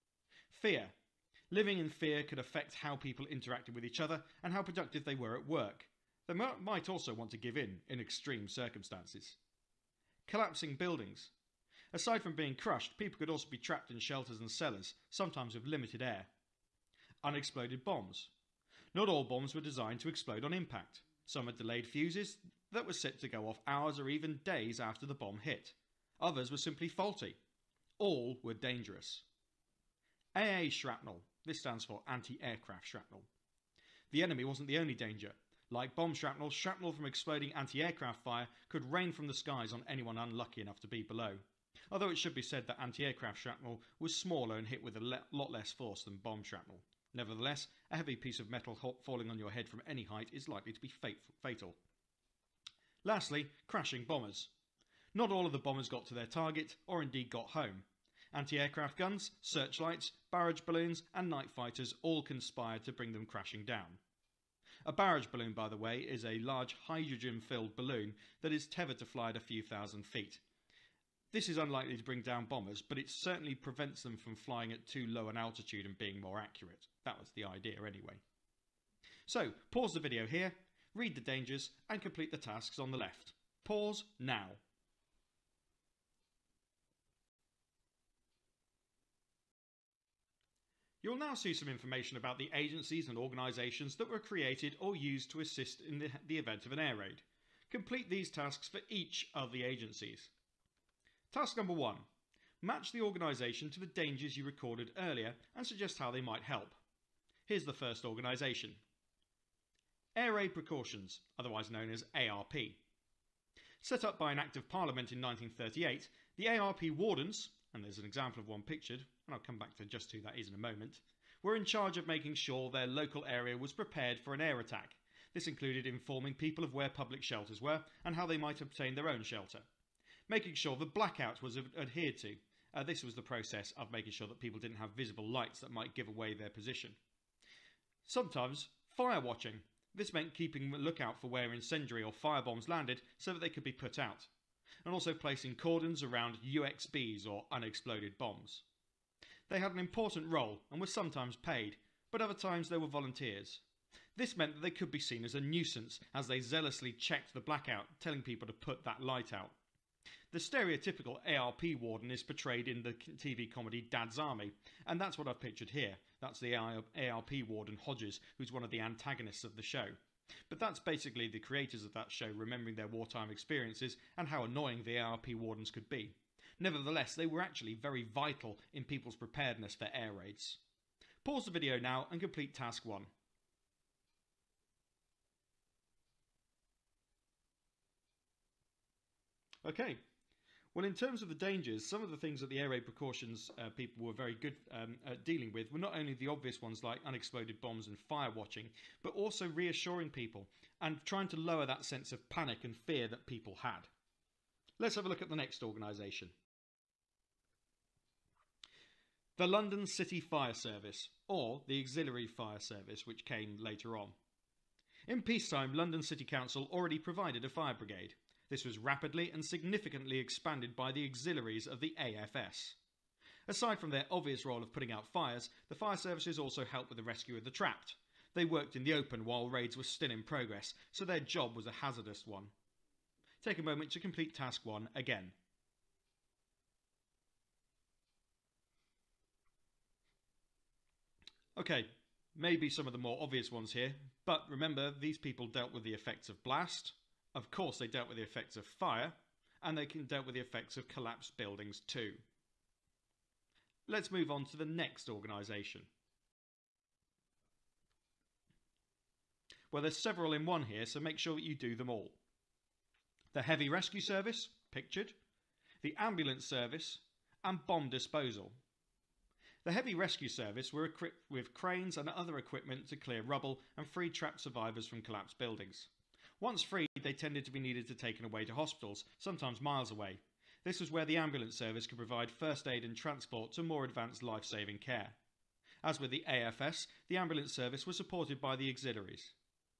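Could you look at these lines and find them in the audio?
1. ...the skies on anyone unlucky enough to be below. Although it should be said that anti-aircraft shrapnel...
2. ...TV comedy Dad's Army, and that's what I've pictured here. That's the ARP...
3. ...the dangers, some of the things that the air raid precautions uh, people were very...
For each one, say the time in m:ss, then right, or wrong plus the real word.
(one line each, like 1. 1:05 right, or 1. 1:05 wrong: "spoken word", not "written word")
1. 0:39 right
2. 2:42 right
3. 3:11 right.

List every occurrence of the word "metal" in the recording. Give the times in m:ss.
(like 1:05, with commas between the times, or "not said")
0:48.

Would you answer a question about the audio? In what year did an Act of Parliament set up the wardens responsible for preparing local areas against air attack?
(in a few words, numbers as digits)
1938.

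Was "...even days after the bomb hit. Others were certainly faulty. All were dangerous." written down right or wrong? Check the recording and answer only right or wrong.
wrong.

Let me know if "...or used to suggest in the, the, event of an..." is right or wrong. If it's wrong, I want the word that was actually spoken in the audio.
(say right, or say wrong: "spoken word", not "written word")
wrong: "assist", not "suggest".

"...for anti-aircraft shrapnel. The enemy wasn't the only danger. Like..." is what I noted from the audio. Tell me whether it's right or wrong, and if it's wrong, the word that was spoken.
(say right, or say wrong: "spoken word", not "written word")
right.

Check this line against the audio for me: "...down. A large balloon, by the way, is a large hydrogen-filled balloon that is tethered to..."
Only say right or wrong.
wrong.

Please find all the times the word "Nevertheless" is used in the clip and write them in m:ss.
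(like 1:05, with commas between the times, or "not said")
0:47, 2:56.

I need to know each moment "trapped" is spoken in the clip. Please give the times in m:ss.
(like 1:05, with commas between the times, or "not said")
0:13, 3:47, 4:34.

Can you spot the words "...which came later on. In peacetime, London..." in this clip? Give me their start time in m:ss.
3:33.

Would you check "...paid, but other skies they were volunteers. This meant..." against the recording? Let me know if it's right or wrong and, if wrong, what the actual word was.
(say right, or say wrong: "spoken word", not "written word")
wrong: "times", not "skies".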